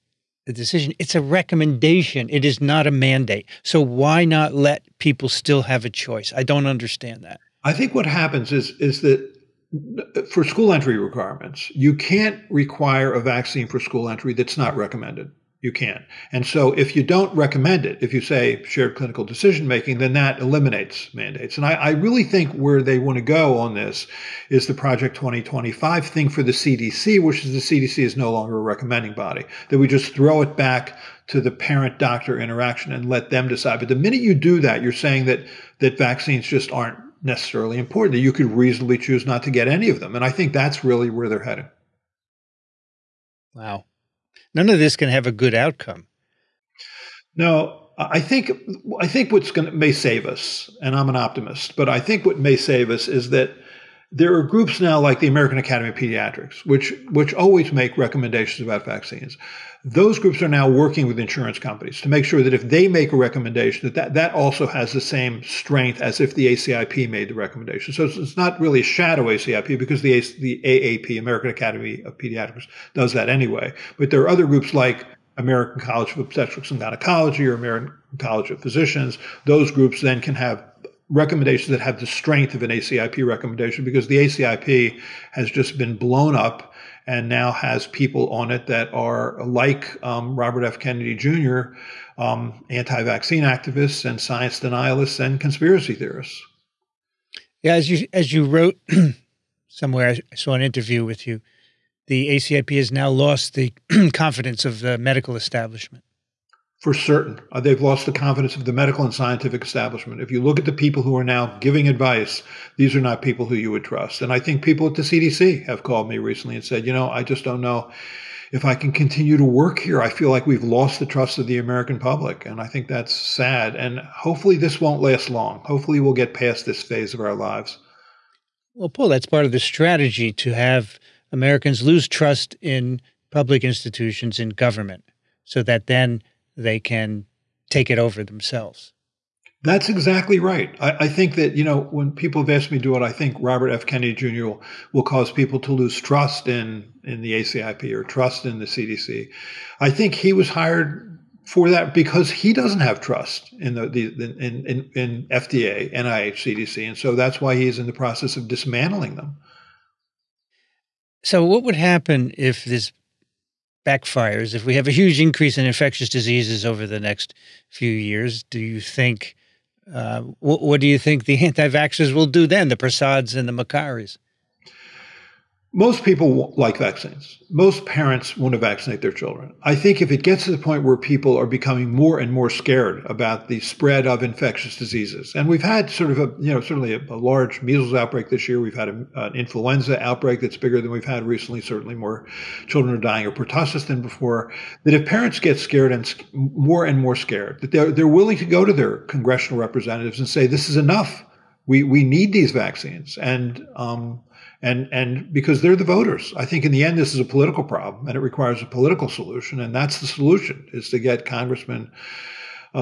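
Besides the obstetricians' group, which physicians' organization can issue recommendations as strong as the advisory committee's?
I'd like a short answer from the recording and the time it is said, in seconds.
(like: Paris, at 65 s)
American College of Physicians, at 77 s.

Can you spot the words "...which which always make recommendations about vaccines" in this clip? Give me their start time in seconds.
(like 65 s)
56 s.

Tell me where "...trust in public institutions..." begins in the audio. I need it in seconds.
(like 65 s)
132 s.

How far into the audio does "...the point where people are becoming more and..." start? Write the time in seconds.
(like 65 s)
180 s.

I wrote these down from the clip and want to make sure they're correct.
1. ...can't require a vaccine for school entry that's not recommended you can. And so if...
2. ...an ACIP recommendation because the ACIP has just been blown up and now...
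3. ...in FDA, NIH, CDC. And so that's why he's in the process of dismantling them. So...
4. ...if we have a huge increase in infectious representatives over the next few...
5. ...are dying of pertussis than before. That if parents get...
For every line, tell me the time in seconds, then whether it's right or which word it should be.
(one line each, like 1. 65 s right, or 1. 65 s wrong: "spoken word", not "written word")
1. 11 s right
2. 82 s right
3. 154 s right
4. 164 s wrong: "diseases", not "representatives"
5. 192 s right.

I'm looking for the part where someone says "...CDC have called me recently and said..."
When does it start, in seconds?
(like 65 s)
115 s.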